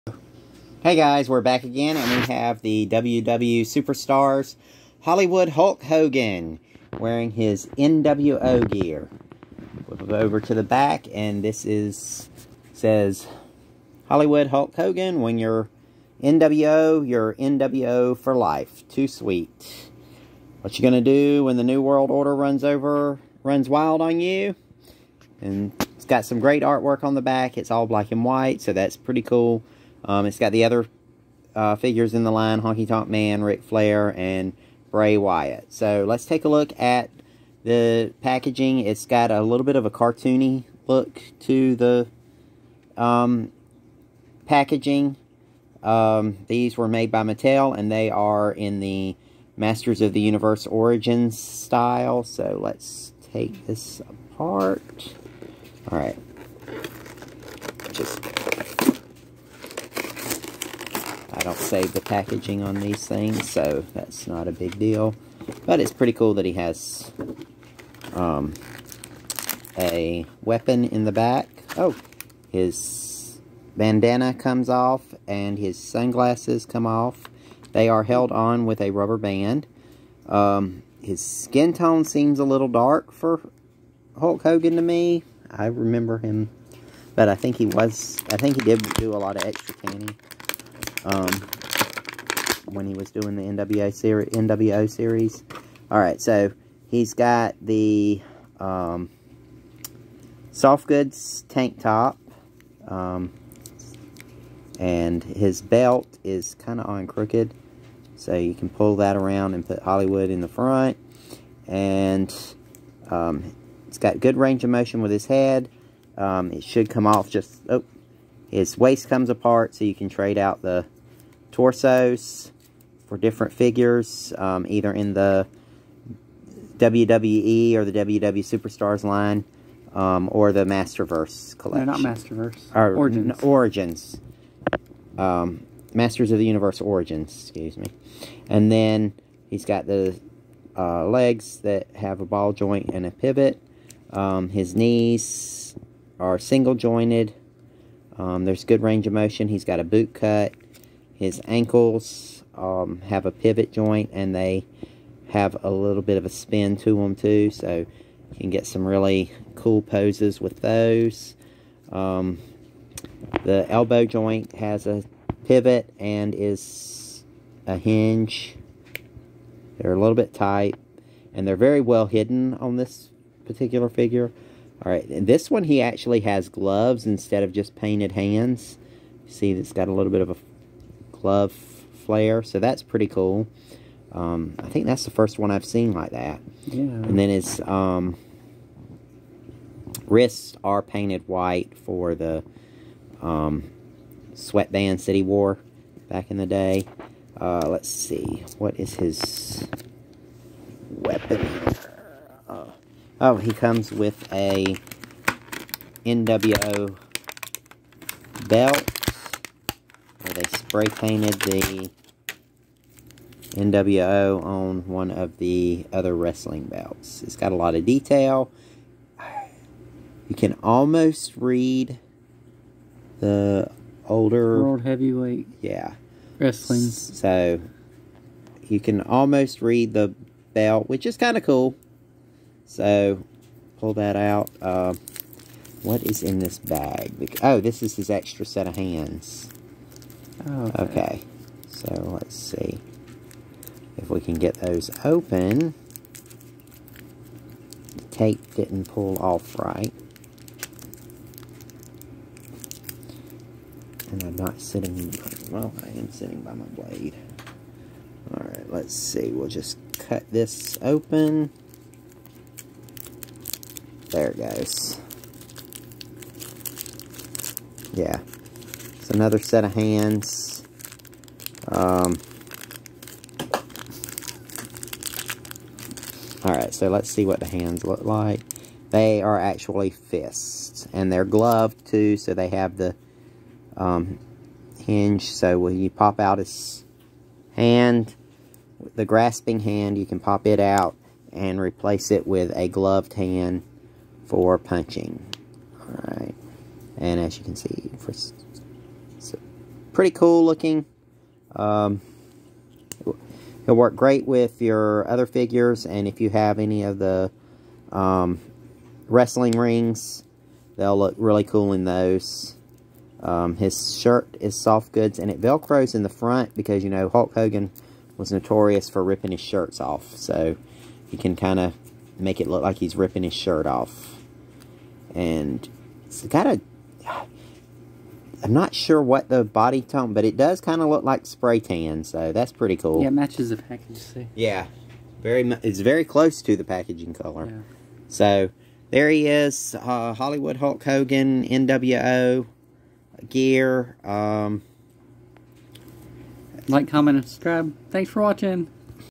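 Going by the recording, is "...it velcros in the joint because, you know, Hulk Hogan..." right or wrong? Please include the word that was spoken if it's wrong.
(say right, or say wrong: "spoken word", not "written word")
wrong: "front", not "joint".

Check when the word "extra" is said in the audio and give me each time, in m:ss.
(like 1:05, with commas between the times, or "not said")
1:29, 3:58.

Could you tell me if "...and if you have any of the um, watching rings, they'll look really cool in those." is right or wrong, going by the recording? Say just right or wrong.
wrong.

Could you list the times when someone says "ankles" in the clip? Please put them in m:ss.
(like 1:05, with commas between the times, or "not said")
2:31.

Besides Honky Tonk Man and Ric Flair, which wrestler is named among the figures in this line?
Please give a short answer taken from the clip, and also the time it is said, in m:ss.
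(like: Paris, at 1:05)
Bray Wyatt, at 0:34.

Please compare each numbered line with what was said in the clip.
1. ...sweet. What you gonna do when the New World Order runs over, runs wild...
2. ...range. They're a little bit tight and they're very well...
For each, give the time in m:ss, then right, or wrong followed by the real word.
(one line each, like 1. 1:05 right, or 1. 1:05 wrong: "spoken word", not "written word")
1. 0:19 right
2. 2:47 wrong: "hinge", not "range".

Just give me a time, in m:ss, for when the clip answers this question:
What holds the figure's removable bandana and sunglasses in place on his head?
1:18.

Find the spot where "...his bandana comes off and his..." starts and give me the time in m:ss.
1:12.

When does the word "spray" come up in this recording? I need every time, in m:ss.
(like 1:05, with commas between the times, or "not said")
3:30, 5:31.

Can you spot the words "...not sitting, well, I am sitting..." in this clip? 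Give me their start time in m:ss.
4:14.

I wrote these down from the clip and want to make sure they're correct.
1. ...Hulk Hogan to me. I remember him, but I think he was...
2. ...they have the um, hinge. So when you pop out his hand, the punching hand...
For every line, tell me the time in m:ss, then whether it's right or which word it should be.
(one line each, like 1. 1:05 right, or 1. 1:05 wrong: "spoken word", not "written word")
1. 1:24 right
2. 4:42 wrong: "grasping", not "punching".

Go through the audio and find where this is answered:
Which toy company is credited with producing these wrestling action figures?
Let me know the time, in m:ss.
0:47.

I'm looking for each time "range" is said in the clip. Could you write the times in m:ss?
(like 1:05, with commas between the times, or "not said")
1:54, 2:28.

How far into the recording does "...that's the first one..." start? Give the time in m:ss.
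3:04.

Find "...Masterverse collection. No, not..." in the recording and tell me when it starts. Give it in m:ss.
2:10.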